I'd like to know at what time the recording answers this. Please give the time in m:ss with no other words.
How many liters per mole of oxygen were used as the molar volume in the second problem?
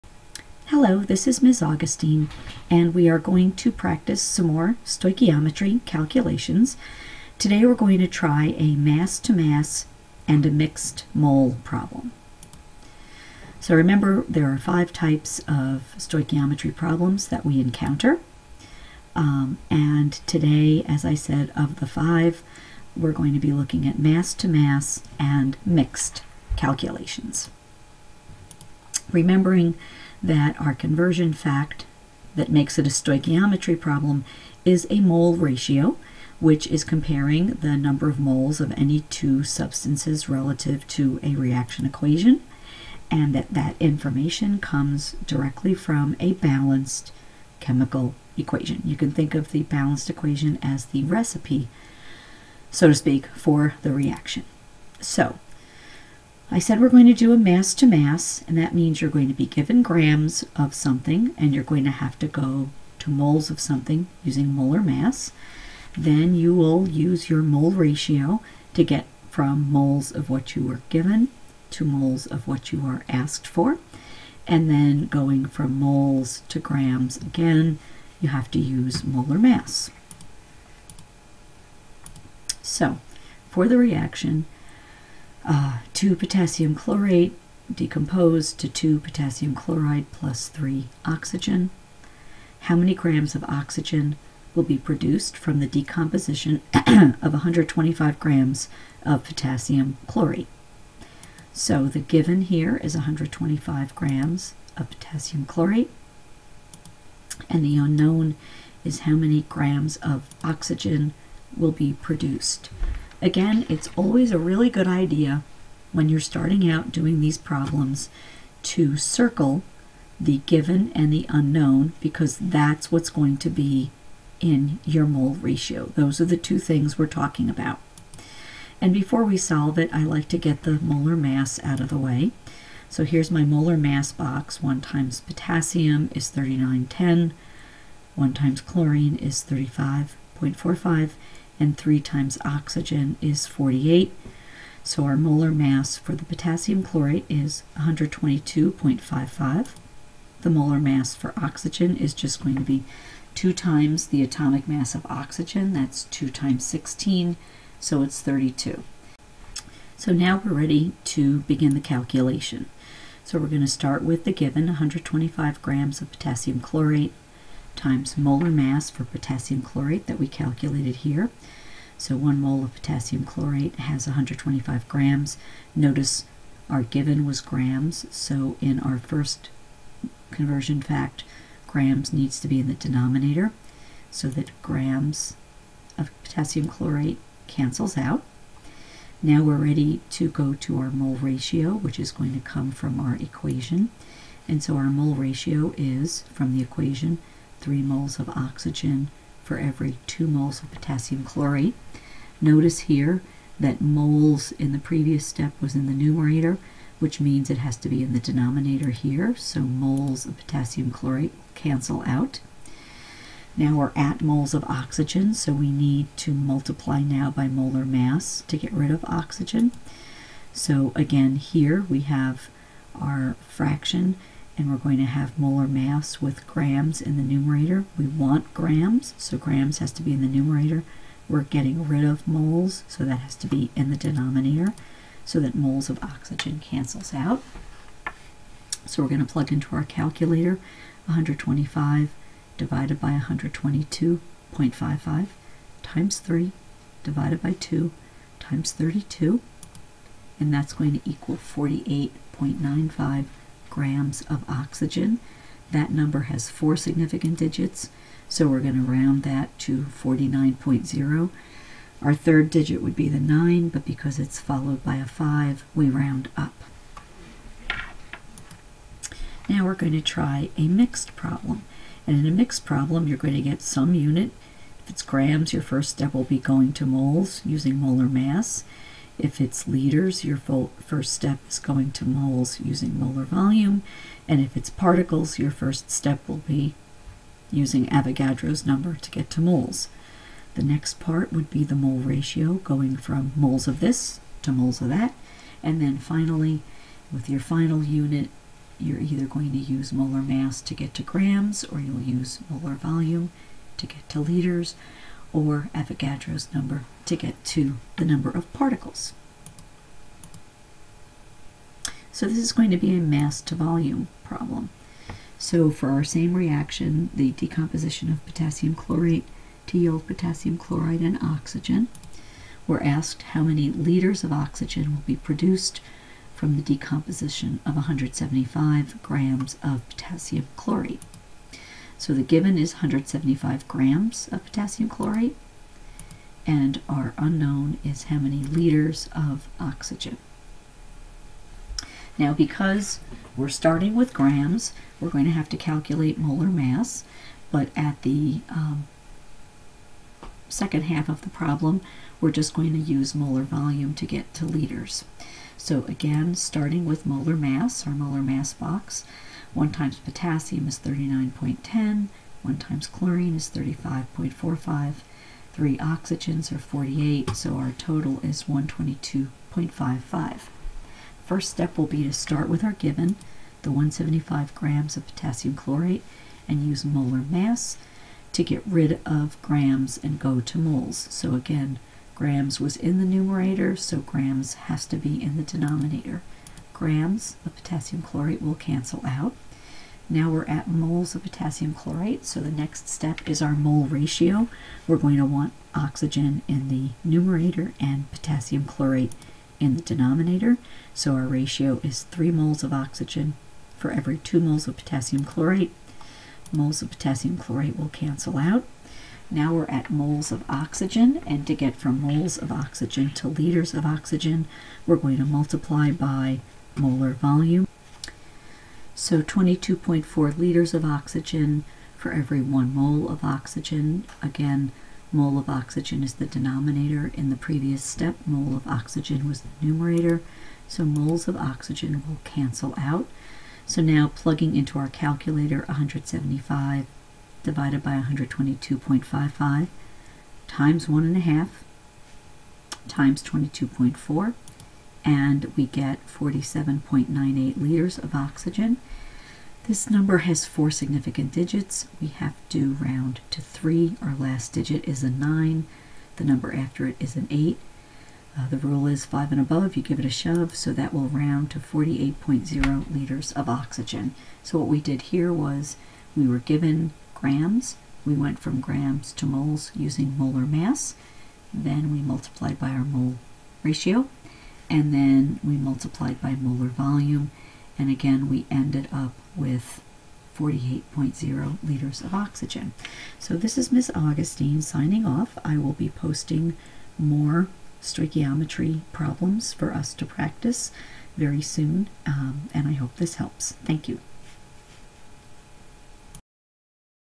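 6:59.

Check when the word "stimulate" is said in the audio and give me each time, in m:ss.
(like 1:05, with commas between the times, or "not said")
not said.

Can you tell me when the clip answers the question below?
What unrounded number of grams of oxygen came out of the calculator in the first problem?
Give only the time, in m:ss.
4:11.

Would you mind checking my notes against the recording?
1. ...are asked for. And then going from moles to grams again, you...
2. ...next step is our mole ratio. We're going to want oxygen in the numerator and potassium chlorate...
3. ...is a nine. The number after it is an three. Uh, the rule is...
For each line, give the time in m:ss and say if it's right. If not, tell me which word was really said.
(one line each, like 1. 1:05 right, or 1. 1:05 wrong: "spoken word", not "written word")
1. 1:12 right
2. 6:32 right
3. 7:34 wrong: "eight", not "three".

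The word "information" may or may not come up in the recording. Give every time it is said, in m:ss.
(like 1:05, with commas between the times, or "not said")
0:43.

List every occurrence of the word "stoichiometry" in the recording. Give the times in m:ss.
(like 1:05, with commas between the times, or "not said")
0:04, 0:15, 0:32, 8:07.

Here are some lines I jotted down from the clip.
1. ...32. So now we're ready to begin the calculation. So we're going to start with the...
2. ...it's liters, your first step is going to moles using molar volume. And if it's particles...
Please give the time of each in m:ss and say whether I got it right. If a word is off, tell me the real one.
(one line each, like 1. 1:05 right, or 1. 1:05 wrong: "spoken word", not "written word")
1. 2:38 right
2. 4:39 right.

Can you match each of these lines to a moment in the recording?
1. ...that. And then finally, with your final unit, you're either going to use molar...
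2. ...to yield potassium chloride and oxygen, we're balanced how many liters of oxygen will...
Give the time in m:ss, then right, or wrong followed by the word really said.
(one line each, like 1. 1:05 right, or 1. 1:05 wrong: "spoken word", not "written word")
1. 4:54 right
2. 5:19 wrong: "asked", not "balanced".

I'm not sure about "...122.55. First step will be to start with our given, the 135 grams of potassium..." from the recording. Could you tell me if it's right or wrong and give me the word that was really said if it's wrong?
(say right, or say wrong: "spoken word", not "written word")
wrong: "175", not "135".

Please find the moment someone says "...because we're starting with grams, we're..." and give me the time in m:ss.
5:42.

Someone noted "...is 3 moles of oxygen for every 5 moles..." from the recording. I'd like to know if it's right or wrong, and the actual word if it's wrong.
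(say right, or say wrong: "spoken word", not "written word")
wrong: "2", not "5".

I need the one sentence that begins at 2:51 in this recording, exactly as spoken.
So one mole of potassium chlorate has 125 grams.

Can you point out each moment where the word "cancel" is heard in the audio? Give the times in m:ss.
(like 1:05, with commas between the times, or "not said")
3:07, 3:31, 3:56, 6:28, 6:47, 7:12.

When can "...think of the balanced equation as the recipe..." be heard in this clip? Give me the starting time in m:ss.
0:49.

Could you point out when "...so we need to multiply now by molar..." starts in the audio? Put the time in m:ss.
3:35.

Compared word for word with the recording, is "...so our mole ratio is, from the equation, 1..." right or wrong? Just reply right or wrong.
wrong.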